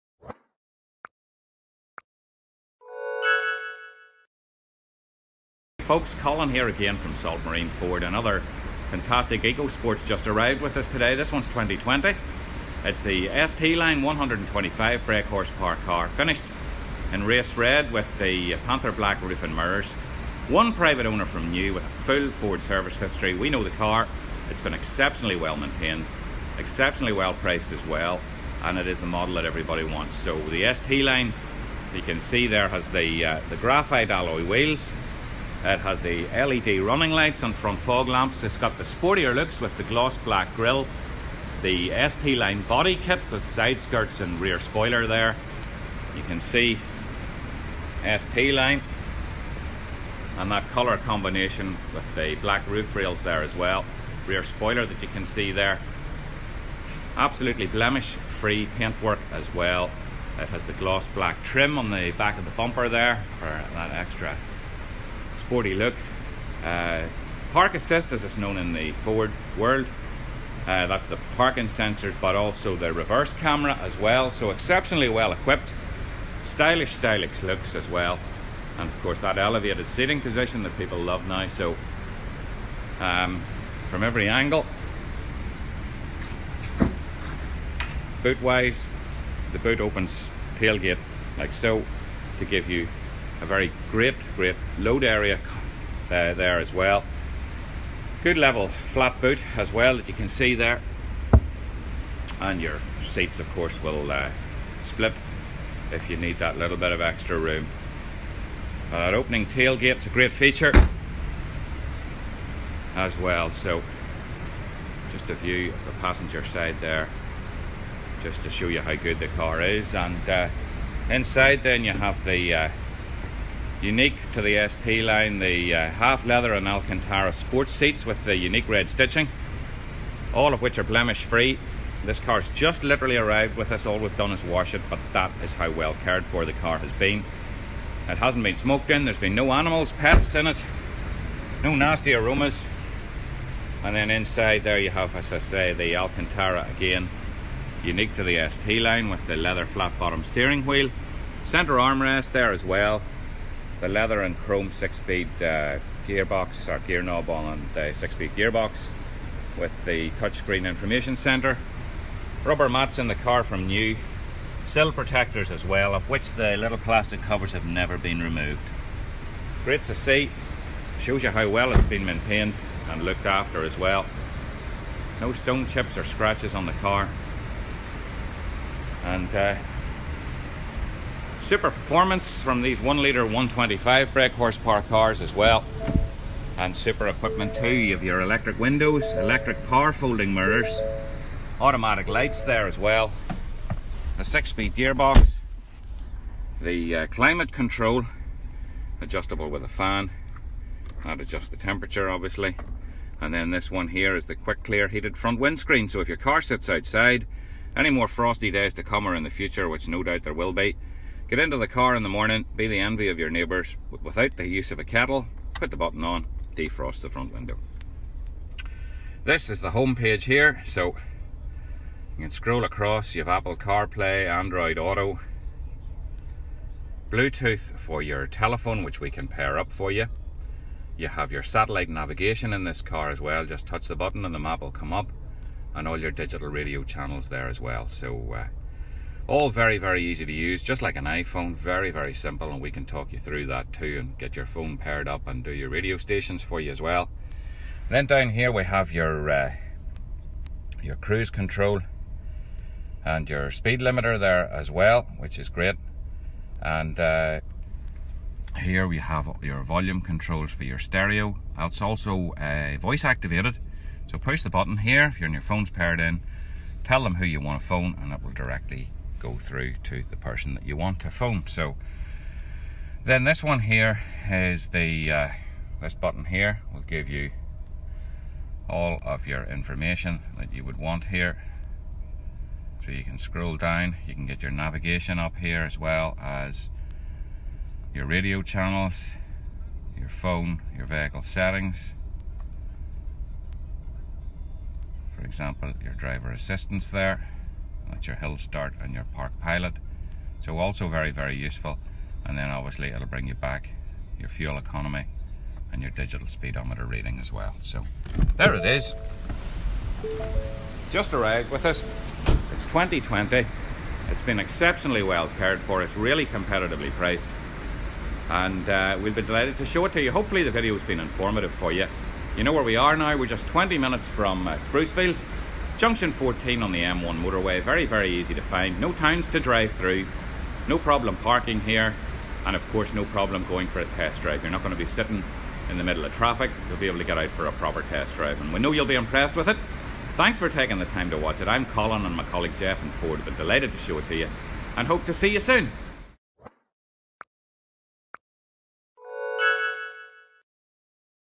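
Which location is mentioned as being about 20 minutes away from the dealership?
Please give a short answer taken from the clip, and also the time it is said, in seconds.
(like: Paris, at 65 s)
Sprucefield, at 324 s.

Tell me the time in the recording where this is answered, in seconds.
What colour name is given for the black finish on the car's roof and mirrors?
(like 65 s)
18 s.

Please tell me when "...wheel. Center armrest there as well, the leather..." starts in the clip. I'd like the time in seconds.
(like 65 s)
150 s.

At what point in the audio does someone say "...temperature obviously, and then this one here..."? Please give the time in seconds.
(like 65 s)
201 s.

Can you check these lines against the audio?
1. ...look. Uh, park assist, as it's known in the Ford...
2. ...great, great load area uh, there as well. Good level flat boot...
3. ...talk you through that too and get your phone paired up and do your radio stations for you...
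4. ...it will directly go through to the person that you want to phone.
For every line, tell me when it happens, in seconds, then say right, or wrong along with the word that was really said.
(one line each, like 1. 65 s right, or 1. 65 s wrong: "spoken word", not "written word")
1. 65 s right
2. 93 s right
3. 242 s right
4. 268 s right.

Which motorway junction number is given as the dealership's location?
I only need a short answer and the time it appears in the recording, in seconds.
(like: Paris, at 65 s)
14, at 325 s.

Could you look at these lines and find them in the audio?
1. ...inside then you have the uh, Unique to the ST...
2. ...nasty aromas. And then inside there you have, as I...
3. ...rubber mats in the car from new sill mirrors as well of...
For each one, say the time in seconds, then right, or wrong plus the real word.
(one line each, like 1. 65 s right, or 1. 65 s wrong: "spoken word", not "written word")
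1. 121 s right
2. 141 s right
3. 162 s wrong: "protectors", not "mirrors".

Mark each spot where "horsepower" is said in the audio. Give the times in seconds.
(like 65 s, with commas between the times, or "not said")
15 s, 184 s.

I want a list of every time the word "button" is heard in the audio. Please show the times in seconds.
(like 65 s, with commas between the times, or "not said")
215 s, 233 s, 264 s, 275 s.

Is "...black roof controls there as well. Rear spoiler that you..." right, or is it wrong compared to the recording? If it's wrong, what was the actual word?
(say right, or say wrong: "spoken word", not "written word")
wrong: "rails", not "controls".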